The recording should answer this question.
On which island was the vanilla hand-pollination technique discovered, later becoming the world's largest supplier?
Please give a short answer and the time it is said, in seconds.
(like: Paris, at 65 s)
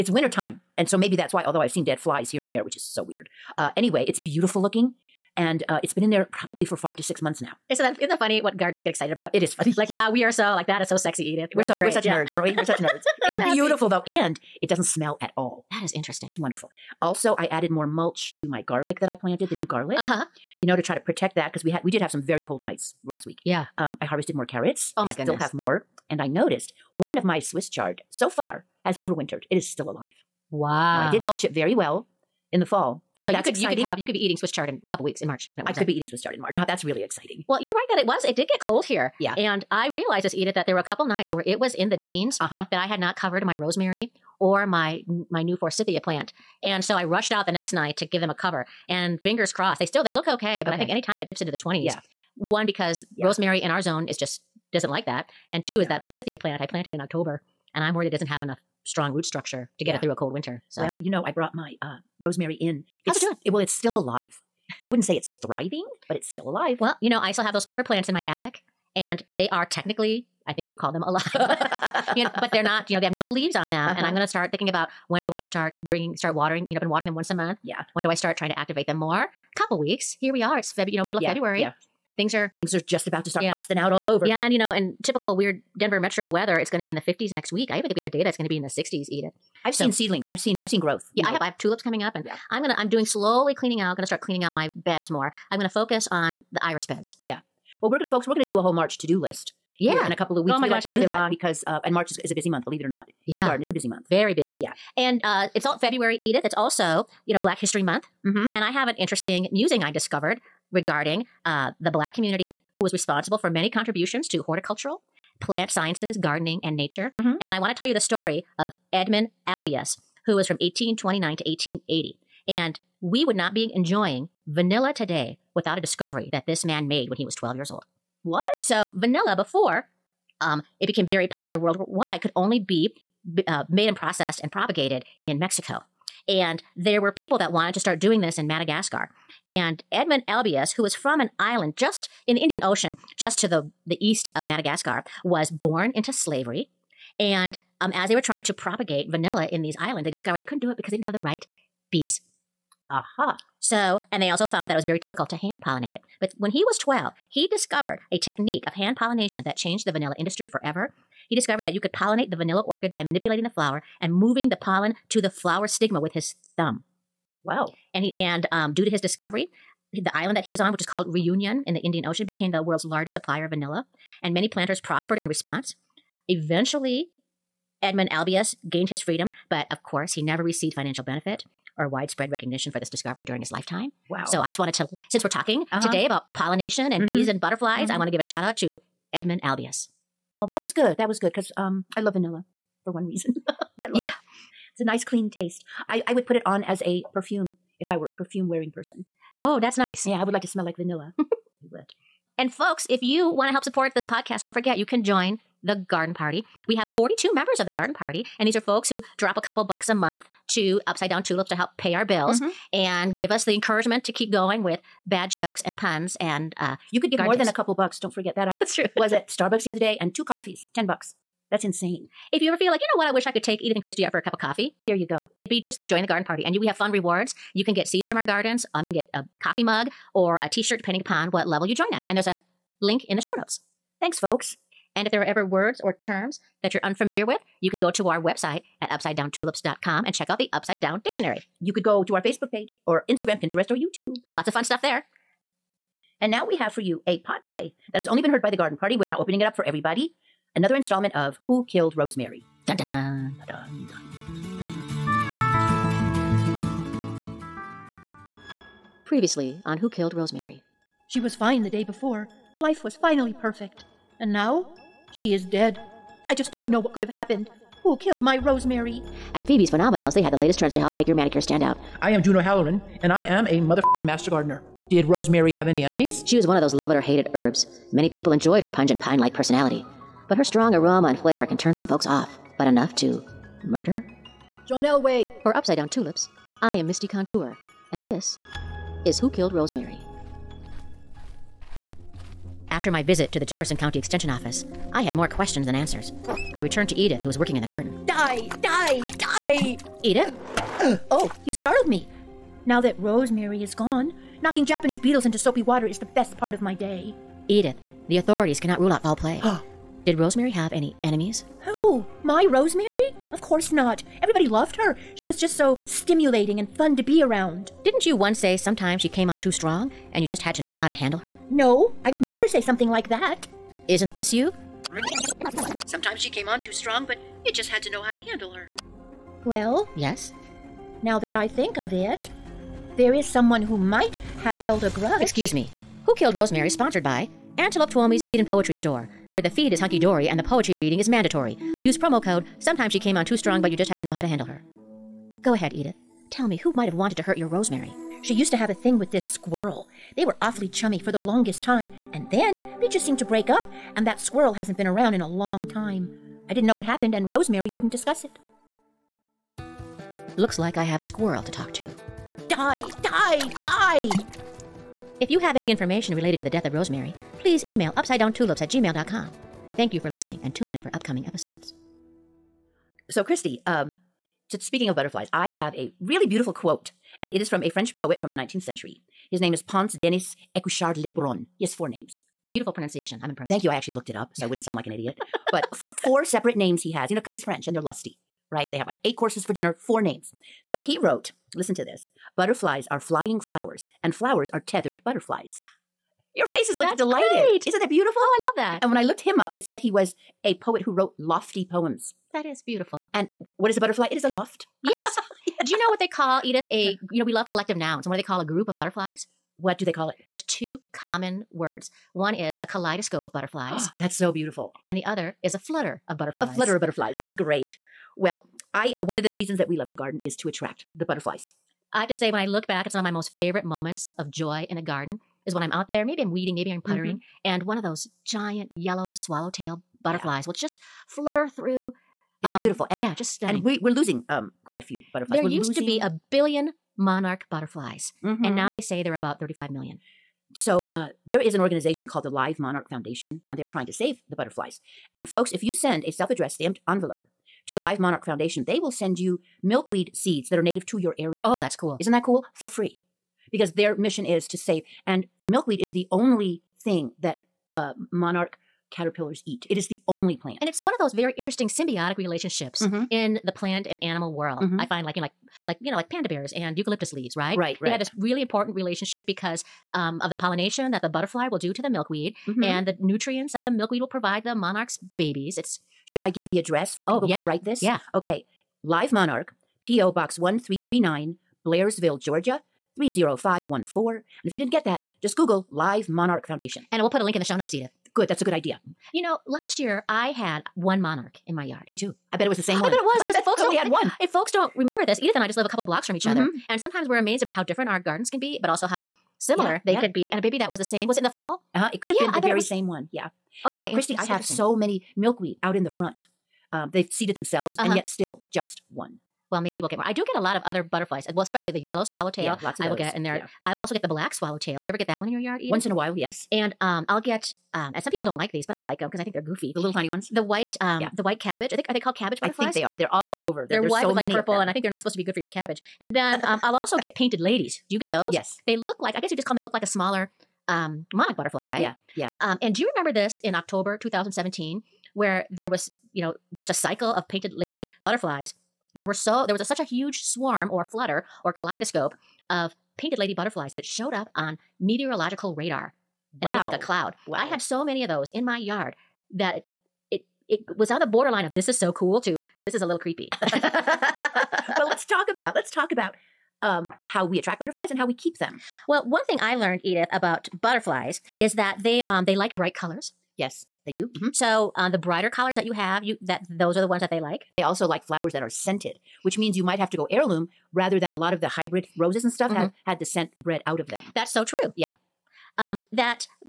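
Reunion, at 171 s.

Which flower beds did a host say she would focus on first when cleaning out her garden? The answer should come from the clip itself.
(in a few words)
iris beds.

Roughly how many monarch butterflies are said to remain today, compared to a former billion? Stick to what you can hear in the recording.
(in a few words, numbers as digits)
35 million.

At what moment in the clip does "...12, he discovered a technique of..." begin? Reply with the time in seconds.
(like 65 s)
156 s.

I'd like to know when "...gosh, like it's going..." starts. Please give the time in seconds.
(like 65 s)
100 s.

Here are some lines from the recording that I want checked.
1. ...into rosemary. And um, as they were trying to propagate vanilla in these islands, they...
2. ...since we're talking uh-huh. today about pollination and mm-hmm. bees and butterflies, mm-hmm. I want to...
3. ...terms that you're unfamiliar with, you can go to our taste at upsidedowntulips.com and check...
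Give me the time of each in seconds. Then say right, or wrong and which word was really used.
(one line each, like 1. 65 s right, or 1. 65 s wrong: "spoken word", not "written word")
1. 145 s wrong: "slavery", not "rosemary"
2. 185 s right
3. 236 s wrong: "website", not "taste".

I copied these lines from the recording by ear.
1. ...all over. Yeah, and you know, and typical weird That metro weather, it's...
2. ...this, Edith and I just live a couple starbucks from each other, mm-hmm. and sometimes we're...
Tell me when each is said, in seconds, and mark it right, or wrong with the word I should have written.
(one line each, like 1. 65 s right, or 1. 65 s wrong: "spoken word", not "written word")
1. 83 s wrong: "Denver", not "That"
2. 495 s wrong: "blocks", not "starbucks".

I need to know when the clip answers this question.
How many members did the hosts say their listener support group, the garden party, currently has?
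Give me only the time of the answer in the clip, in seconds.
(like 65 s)
206 s.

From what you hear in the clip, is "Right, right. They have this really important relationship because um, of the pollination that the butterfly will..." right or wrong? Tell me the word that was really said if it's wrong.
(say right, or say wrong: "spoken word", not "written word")
right.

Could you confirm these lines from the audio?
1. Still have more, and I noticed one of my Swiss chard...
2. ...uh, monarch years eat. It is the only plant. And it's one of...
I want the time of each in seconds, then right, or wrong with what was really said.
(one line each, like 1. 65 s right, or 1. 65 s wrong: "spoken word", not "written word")
1. 25 s right
2. 457 s wrong: "caterpillars", not "years".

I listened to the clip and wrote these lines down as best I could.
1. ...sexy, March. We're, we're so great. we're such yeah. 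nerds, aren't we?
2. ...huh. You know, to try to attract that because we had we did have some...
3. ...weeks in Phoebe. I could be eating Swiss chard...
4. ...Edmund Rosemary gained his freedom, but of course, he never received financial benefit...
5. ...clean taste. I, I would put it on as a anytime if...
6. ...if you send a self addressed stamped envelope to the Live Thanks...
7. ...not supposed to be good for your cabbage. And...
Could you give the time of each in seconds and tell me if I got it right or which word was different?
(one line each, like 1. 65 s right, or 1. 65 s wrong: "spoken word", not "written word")
1. 10 s wrong: "Edith", not "March"
2. 20 s wrong: "protect", not "attract"
3. 35 s wrong: "March", not "Phoebe"
4. 177 s wrong: "Albius", not "Rosemary"
5. 195 s wrong: "perfume", not "anytime"
6. 445 s wrong: "Monarch", not "Thanks"
7. 524 s right.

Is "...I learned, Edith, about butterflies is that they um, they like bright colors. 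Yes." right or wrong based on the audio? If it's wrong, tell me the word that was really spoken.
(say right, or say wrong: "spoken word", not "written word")
right.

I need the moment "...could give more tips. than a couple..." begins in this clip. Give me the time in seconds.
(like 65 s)
216 s.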